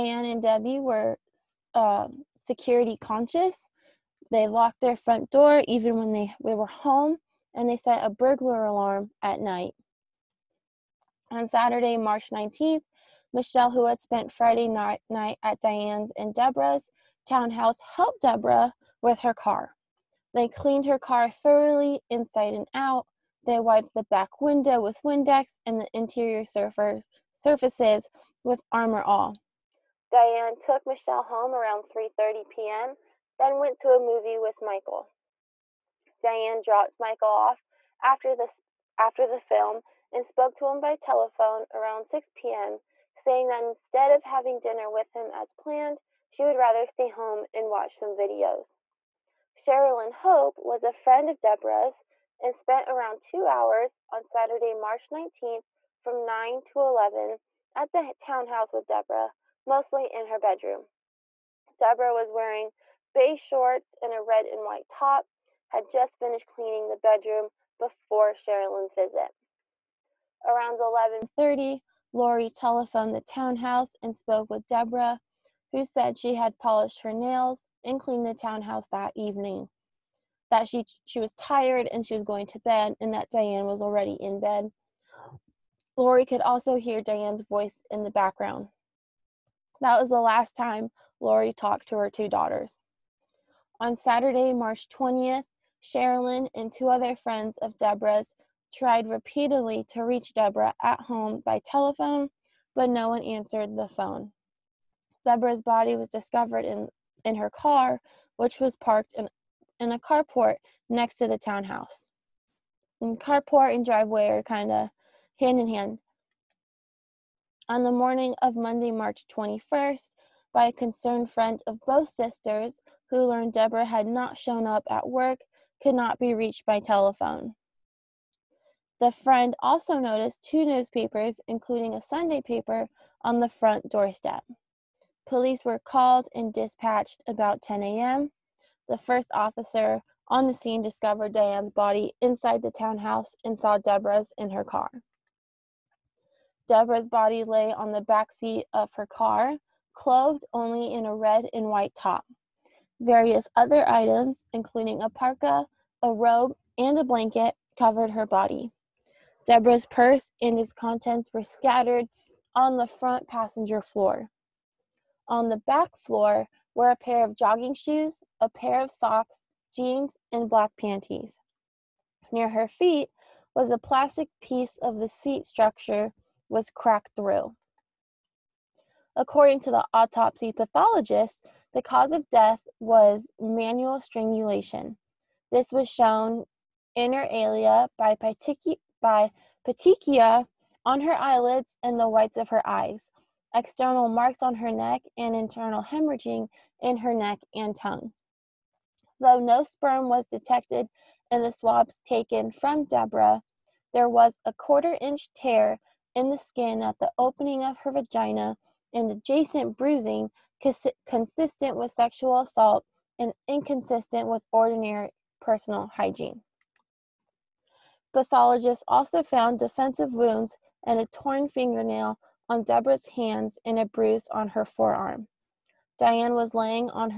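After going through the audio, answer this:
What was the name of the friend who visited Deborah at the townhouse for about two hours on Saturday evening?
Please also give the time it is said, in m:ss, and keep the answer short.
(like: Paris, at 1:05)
Sherilyn Hope, at 0:49.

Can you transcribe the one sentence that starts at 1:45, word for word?
Deborah's body was discovered in, in her car, which was parked in, in a carport next to the townhouse.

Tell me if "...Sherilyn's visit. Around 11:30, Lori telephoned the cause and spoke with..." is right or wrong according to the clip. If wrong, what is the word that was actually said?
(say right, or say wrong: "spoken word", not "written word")
wrong: "townhouse", not "cause".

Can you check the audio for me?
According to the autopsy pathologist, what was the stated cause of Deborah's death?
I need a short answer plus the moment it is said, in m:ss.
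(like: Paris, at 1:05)
Manual strangulation, at 3:03.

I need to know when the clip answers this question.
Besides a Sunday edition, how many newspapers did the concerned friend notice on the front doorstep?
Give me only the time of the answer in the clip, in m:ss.
2:10.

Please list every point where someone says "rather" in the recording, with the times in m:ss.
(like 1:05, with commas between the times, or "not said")
0:46.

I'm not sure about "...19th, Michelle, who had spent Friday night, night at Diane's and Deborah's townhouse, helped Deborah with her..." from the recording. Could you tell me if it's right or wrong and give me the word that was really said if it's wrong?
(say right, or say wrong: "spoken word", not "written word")
right.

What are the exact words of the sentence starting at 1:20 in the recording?
That she she was tired and she was going to bed and that Diane was already in bed.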